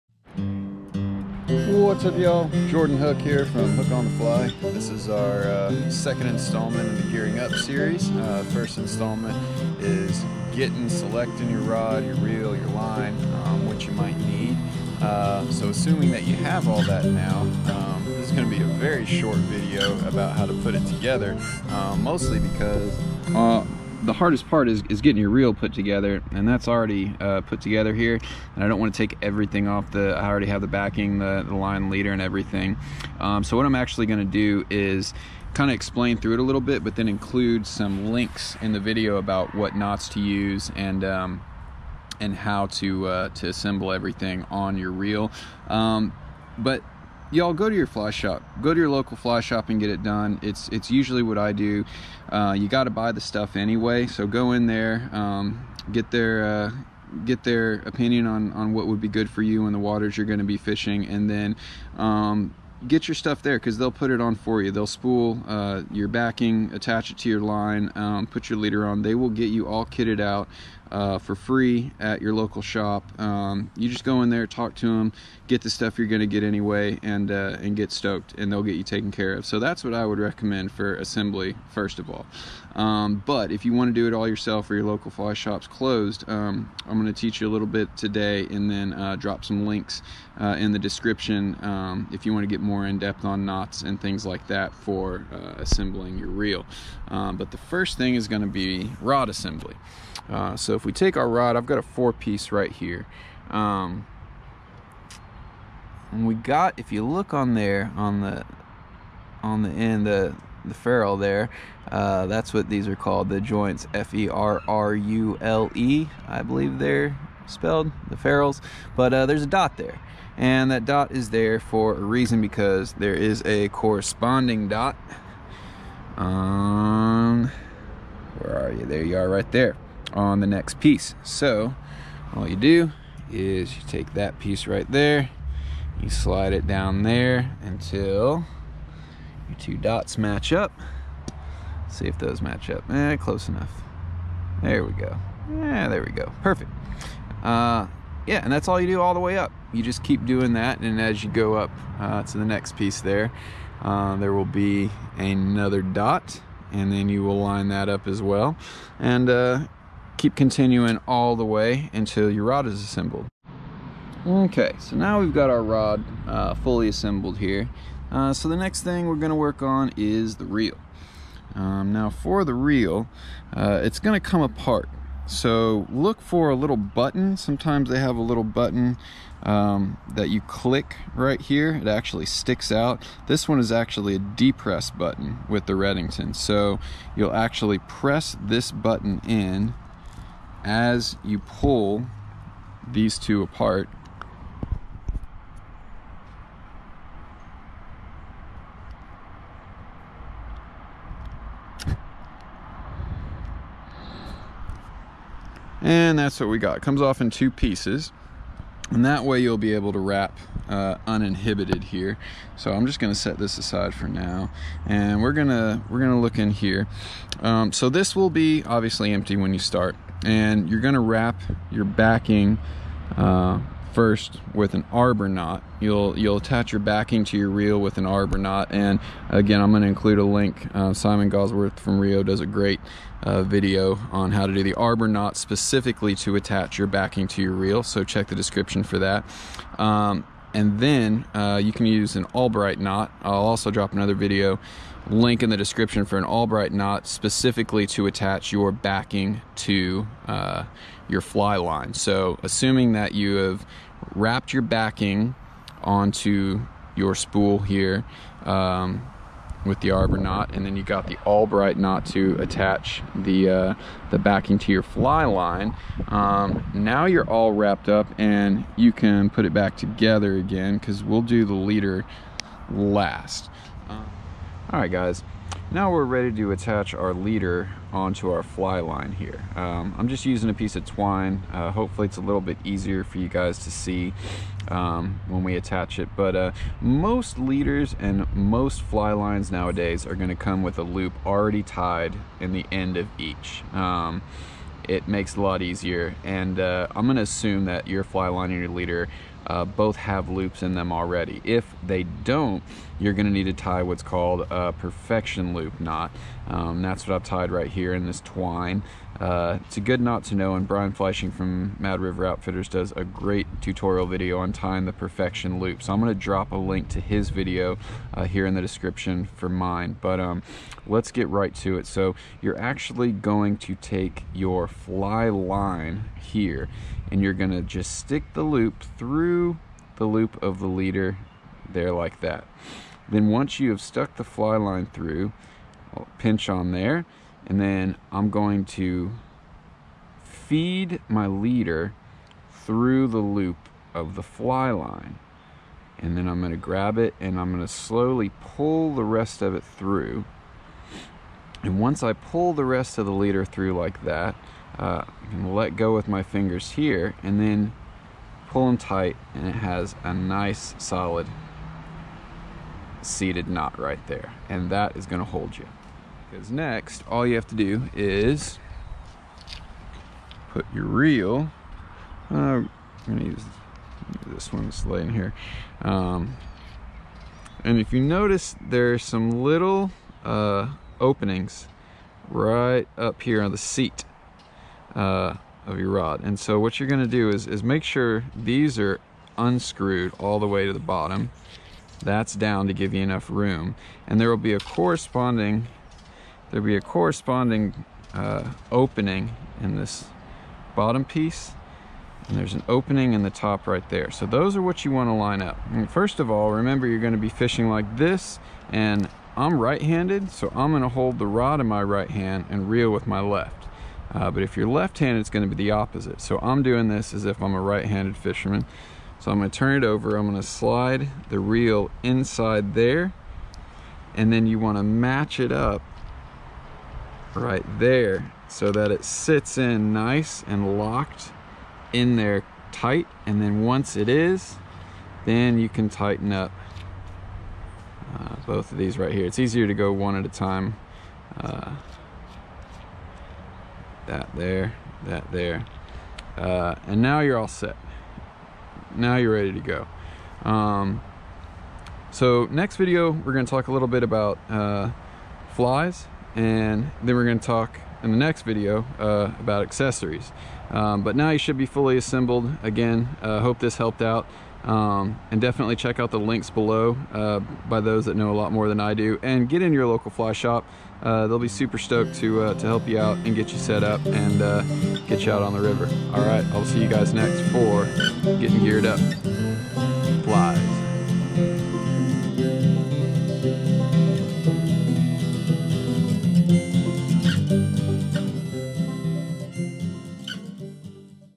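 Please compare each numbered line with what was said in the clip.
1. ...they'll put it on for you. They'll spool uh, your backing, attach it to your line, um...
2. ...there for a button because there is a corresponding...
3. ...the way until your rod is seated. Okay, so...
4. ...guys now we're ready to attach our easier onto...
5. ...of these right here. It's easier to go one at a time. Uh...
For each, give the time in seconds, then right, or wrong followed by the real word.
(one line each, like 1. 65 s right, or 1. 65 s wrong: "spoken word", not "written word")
1. 63 s right
2. 121 s wrong: "reason", not "button"
3. 161 s wrong: "assembled", not "seated"
4. 274 s wrong: "leader", not "easier"
5. 438 s right.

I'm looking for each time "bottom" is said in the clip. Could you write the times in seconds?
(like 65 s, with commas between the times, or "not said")
390 s, 400 s.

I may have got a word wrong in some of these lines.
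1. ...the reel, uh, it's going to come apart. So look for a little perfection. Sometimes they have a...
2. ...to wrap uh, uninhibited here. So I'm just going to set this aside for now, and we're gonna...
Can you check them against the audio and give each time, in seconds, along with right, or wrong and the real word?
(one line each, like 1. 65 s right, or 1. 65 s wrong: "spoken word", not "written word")
1. 172 s wrong: "button", not "perfection"
2. 209 s right.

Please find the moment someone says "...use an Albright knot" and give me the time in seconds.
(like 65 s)
241 s.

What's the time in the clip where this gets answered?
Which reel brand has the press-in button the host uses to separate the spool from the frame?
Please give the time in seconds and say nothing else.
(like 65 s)
185 s.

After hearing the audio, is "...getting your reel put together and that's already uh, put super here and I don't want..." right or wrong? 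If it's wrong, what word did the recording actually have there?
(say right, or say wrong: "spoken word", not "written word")
wrong: "together", not "super".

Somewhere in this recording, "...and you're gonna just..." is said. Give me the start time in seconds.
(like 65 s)
327 s.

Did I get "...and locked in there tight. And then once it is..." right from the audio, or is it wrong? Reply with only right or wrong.
right.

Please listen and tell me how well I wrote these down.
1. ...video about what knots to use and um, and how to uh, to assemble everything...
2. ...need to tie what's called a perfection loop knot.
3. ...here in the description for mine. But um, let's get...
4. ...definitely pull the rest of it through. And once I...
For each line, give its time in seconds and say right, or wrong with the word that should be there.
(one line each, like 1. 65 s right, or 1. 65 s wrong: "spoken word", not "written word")
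1. 38 s right
2. 303 s right
3. 318 s right
4. 347 s wrong: "slowly", not "definitely".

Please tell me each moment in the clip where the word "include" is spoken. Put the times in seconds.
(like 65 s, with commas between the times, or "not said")
37 s, 229 s.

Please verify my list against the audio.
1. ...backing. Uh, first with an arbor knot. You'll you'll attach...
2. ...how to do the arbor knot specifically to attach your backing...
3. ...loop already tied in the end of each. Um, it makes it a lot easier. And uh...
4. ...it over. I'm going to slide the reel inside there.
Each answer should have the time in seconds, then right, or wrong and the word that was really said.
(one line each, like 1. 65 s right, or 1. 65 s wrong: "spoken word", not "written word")
1. 221 s right
2. 234 s right
3. 290 s right
4. 419 s right.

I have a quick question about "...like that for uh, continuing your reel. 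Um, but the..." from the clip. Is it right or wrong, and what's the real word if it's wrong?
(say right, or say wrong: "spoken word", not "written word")
wrong: "assembling", not "continuing".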